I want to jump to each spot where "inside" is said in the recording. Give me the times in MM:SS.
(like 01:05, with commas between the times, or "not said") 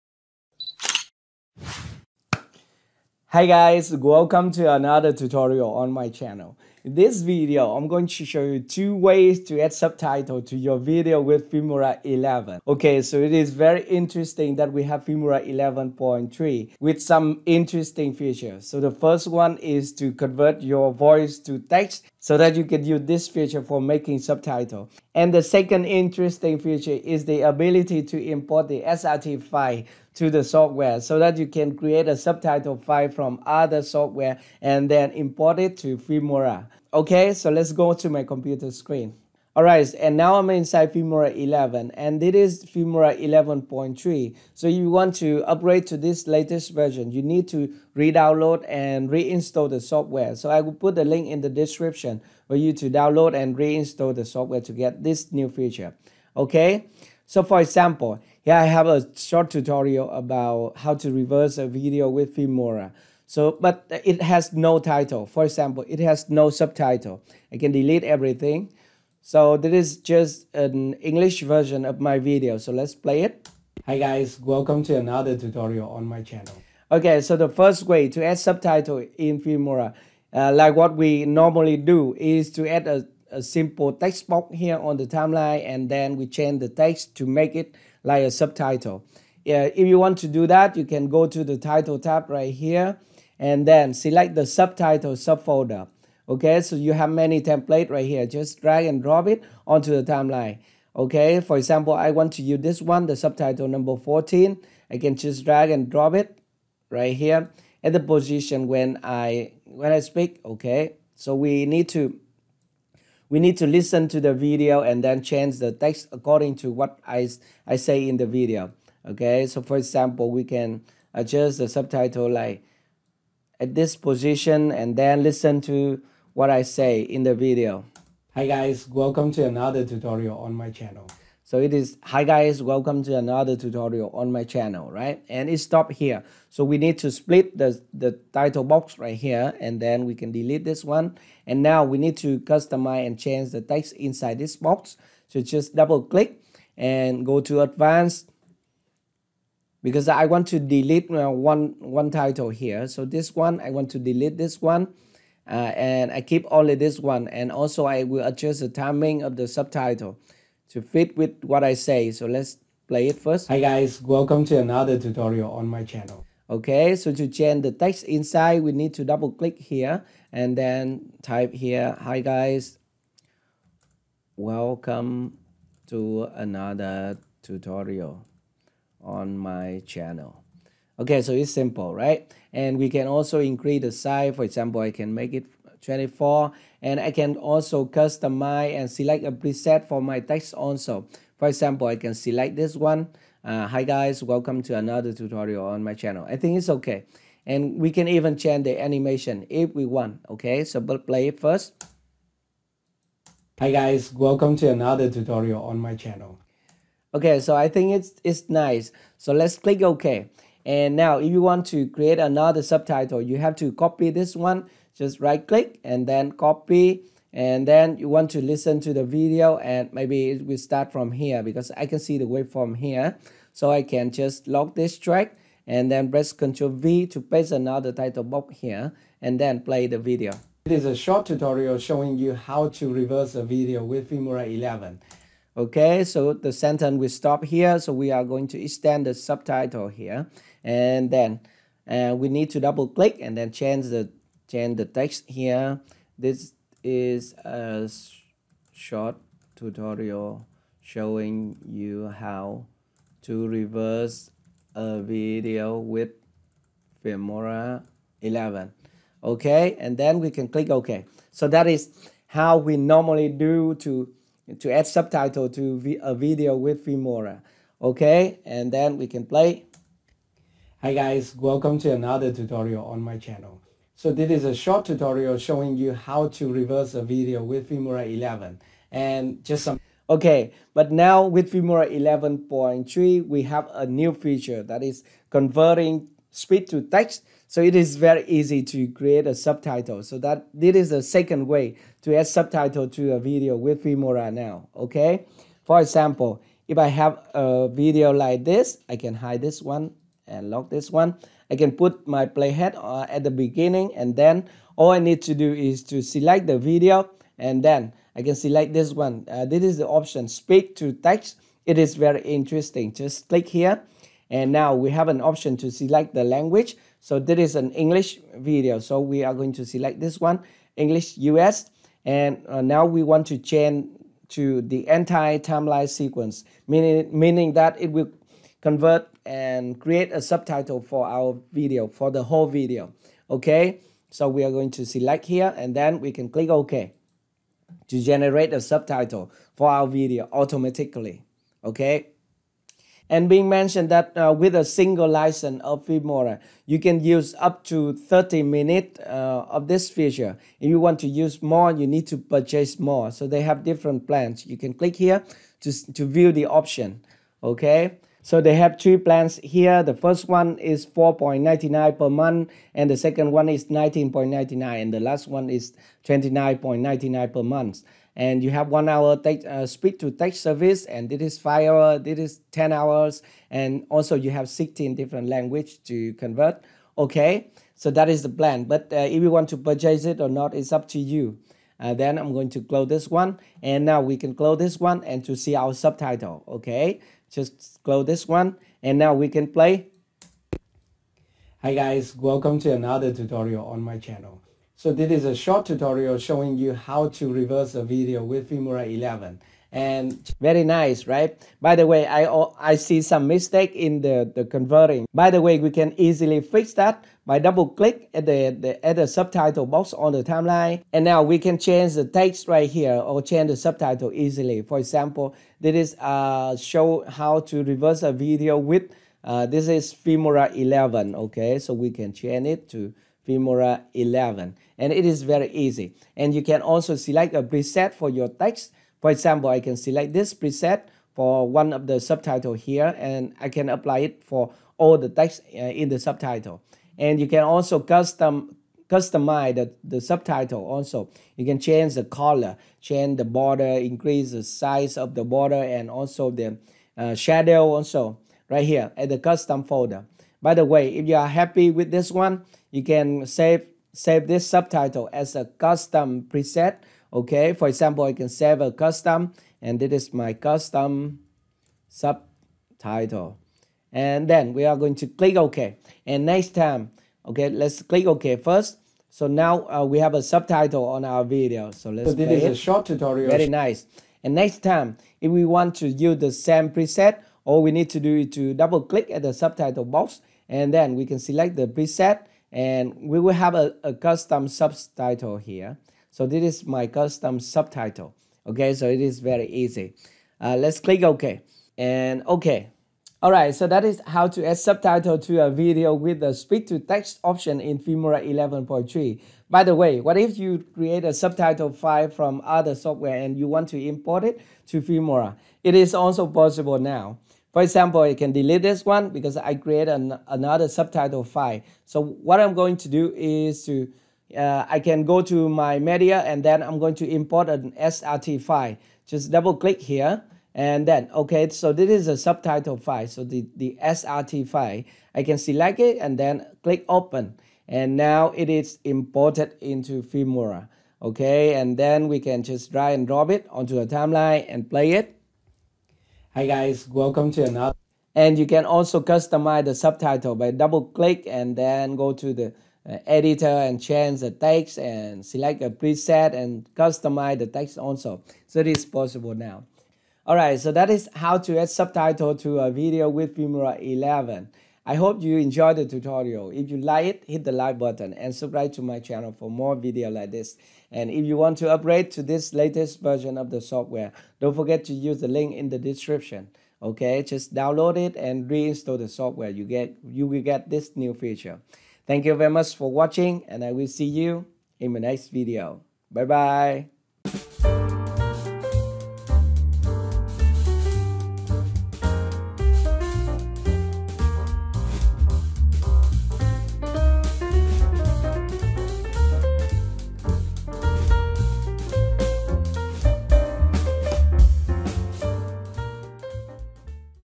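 00:40, 02:23, 02:48.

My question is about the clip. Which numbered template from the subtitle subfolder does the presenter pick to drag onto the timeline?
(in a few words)
14.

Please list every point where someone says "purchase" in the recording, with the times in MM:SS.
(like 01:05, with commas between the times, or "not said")
05:52, 06:19.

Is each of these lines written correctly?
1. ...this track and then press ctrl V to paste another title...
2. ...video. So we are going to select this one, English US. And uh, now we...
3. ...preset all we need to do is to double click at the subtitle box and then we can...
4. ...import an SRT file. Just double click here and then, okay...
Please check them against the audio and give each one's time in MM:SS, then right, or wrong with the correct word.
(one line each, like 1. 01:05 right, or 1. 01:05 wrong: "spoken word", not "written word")
1. 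03:44 right
2. 05:18 right
3. 07:56 right
4. 08:37 right.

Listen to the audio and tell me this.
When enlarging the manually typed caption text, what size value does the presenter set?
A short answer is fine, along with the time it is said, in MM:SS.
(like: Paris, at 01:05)
24, at 03:04.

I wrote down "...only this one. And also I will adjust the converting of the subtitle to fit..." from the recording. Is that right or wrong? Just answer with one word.
wrong.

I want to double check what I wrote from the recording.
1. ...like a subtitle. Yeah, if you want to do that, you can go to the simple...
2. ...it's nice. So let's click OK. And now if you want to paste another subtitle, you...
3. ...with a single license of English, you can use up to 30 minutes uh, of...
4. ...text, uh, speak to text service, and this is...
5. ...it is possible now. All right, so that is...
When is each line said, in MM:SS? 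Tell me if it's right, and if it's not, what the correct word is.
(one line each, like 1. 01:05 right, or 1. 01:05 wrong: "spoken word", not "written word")
1. 01:28 wrong: "title", not "simple"
2. 03:28 wrong: "create", not "paste"
3. 05:44 wrong: "Filmora", not "English"
4. 06:09 right
5. 09:08 right.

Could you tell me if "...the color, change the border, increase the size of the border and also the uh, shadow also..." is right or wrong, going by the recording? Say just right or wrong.
right.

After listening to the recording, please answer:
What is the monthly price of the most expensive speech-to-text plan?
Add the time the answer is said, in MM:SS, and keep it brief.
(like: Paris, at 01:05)
29.99, at 06:06.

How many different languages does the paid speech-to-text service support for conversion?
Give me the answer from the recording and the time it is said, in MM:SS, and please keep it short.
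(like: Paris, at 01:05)
16, at 06:14.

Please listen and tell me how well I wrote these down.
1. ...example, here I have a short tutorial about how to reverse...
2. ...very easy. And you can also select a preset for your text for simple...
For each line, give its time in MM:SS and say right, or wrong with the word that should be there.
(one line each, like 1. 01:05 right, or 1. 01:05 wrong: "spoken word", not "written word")
1. 00:57 right
2. 07:05 wrong: "example", not "simple".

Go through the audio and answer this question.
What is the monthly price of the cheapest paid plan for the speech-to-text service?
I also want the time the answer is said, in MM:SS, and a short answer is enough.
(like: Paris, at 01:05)
4.99, at 06:00.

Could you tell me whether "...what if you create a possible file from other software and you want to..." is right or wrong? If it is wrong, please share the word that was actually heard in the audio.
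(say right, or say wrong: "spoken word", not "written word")
wrong: "subtitle", not "possible".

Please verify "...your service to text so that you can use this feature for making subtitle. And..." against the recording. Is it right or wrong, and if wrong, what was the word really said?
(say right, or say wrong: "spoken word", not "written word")
wrong: "voice", not "service".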